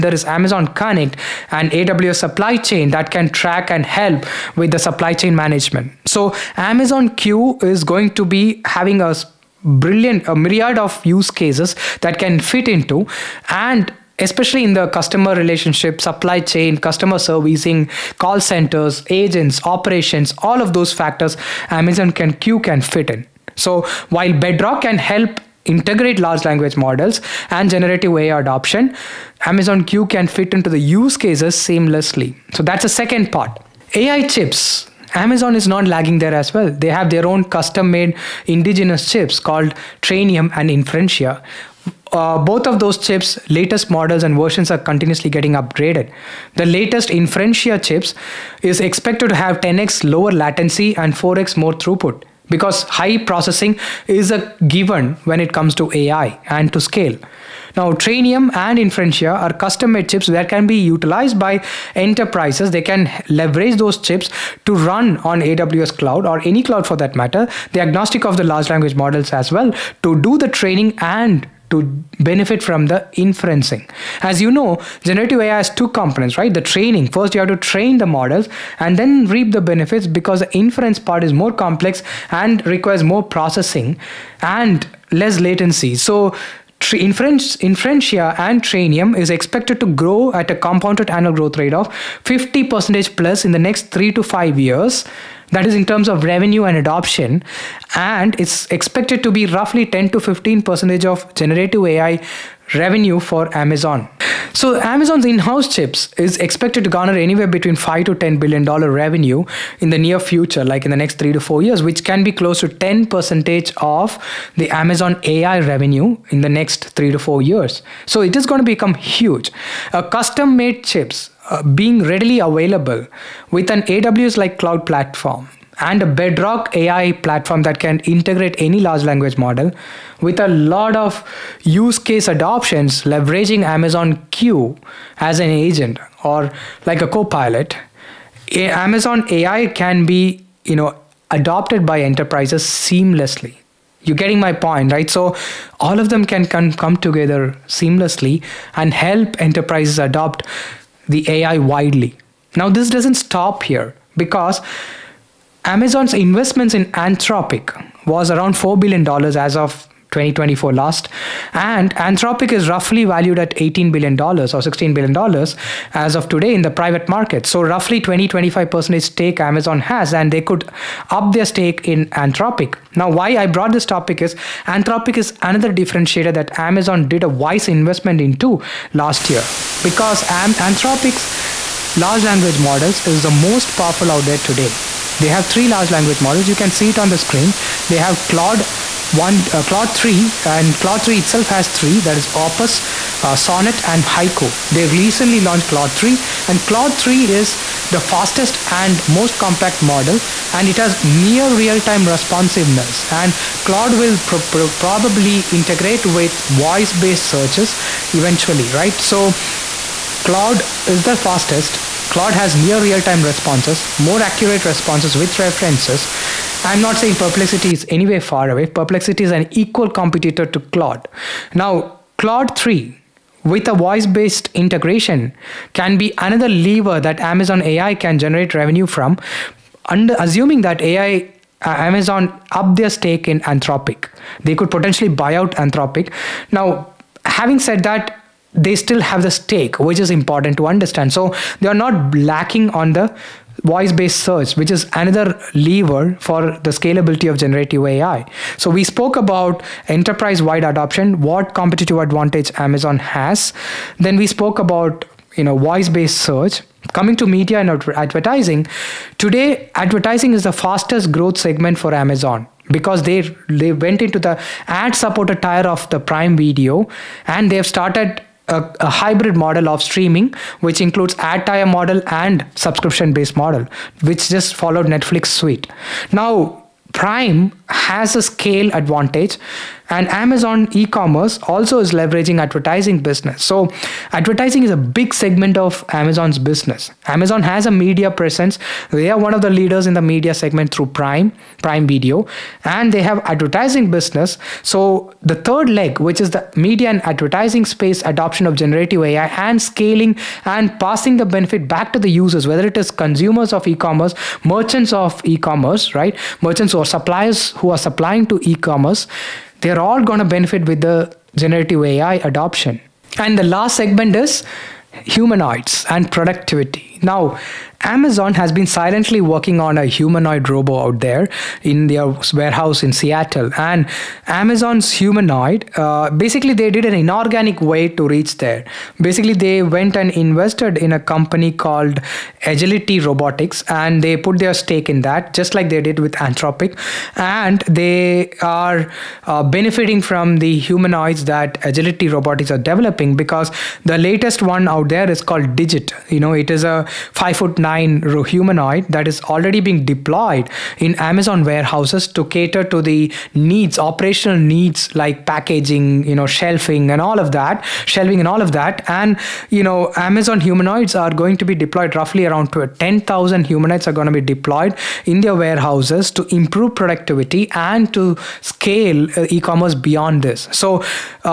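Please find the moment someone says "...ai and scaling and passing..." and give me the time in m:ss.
4:59.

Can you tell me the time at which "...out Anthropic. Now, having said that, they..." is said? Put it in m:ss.
3:55.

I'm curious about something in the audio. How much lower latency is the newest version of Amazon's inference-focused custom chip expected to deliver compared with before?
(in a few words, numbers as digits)
10x.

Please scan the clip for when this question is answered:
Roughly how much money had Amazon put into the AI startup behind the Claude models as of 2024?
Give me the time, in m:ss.
2:38.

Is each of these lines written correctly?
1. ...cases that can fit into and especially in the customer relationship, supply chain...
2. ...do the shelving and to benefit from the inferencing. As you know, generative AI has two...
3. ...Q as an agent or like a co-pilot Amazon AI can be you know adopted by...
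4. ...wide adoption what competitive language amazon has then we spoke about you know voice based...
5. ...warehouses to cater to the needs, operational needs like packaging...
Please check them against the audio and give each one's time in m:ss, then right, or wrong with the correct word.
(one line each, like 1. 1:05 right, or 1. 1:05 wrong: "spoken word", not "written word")
1. 0:11 right
2. 1:10 wrong: "training", not "shelving"
3. 2:14 right
4. 4:10 wrong: "advantage", not "language"
5. 5:51 right.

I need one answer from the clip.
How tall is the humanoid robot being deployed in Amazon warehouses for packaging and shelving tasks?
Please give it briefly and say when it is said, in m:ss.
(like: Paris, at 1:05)
5 foot 9, at 5:47.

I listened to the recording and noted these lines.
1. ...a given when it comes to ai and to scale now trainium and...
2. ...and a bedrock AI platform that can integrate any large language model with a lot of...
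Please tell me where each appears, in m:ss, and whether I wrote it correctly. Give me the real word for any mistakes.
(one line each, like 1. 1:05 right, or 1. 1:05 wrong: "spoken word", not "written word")
1. 0:54 right
2. 2:05 right.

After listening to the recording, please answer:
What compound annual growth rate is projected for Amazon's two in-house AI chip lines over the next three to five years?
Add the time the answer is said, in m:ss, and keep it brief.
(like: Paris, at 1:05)
50% plus, at 1:32.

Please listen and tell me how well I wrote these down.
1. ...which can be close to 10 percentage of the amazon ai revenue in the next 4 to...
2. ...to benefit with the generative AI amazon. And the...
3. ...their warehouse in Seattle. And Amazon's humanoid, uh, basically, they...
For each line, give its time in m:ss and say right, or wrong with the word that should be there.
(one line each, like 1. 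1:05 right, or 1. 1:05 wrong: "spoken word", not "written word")
1. 1:51 wrong: "3", not "4"
2. 5:10 wrong: "adoption", not "amazon"
3. 5:21 right.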